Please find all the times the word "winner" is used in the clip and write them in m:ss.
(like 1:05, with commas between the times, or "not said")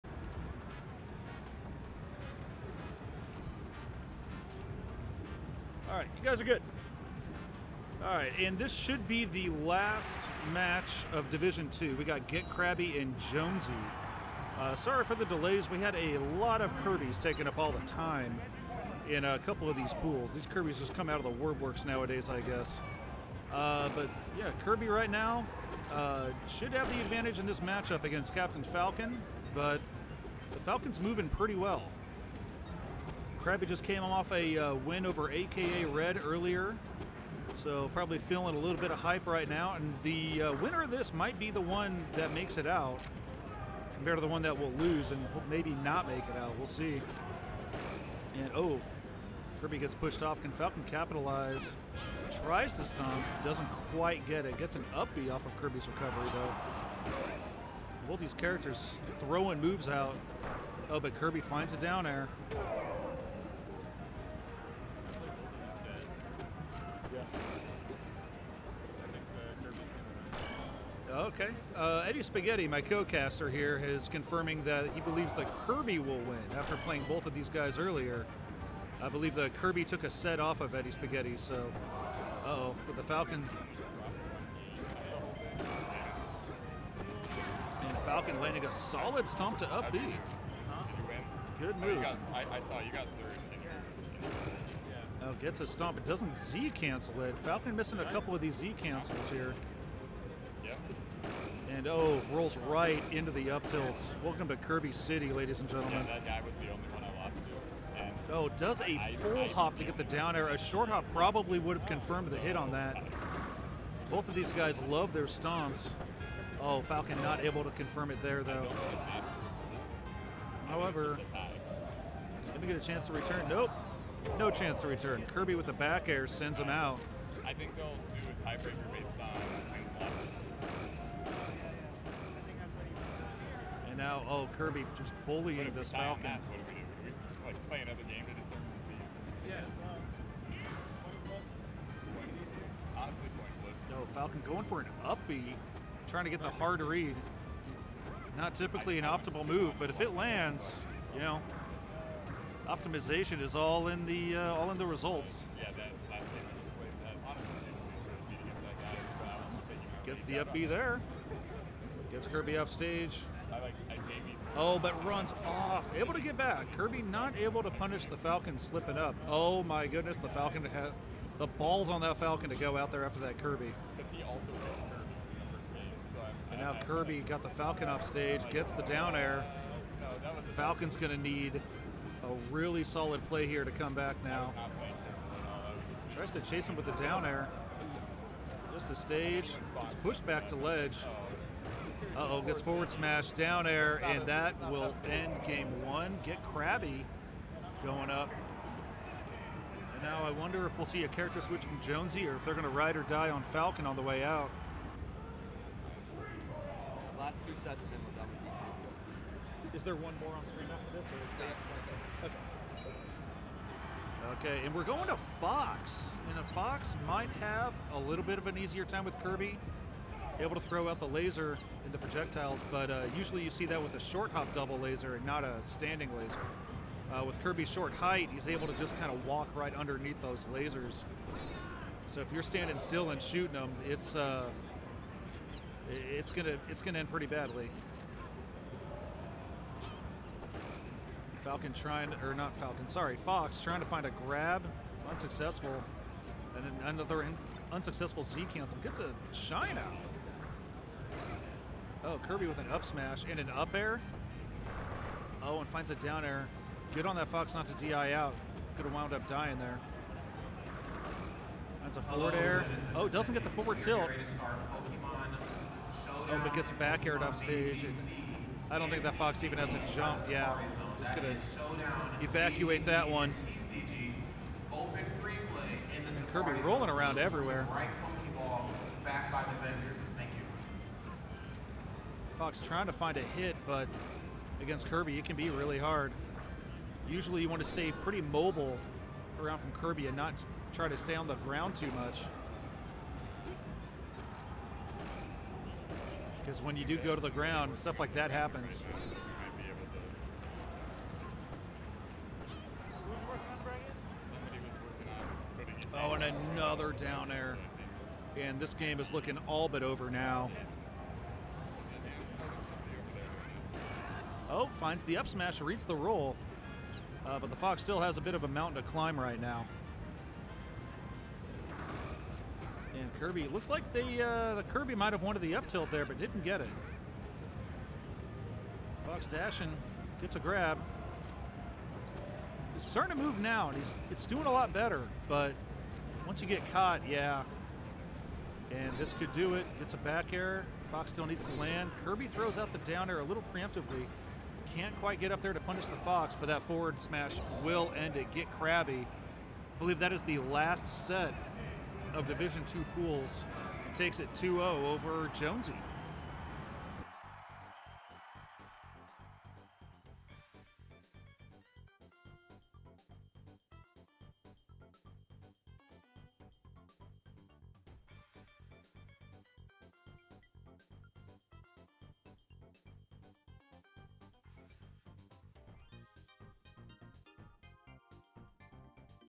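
0:40.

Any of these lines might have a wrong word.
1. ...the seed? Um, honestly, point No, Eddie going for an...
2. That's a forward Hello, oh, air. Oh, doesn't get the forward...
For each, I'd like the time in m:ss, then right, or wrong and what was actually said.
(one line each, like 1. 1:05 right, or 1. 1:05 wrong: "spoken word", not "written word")
1. 2:18 wrong: "Falcon", not "Eddie"
2. 4:21 right.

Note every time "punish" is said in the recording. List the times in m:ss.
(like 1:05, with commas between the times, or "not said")
2:47, 5:45.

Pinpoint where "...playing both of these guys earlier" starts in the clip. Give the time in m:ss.
1:16.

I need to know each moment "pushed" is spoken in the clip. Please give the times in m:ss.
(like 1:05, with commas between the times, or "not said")
0:49, 3:10.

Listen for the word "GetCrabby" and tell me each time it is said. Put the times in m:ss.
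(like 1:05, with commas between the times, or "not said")
0:12, 3:16, 5:48.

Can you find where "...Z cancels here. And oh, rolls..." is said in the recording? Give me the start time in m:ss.
1:38.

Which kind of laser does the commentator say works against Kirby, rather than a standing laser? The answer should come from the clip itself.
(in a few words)
Short hop double laser.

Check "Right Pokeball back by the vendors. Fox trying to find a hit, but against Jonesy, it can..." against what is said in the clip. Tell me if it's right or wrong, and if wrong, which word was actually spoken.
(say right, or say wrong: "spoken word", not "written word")
wrong: "Kirby", not "Jonesy".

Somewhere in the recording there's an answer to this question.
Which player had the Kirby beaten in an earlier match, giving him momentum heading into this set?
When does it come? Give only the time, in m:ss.
0:35.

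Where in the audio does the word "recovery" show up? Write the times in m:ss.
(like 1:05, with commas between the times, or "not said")
0:55.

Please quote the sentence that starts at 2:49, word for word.
Oh my goodness, the Falcon had the balls on that Falcon to go out there after that Kirby.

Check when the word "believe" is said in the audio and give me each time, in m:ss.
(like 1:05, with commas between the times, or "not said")
1:15, 1:19, 5:49.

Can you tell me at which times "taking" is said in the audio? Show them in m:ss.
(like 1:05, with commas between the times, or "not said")
0:17.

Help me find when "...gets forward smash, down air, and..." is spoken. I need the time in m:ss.
3:12.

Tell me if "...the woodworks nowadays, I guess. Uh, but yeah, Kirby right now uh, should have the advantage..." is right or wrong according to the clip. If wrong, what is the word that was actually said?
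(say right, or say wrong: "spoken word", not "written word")
right.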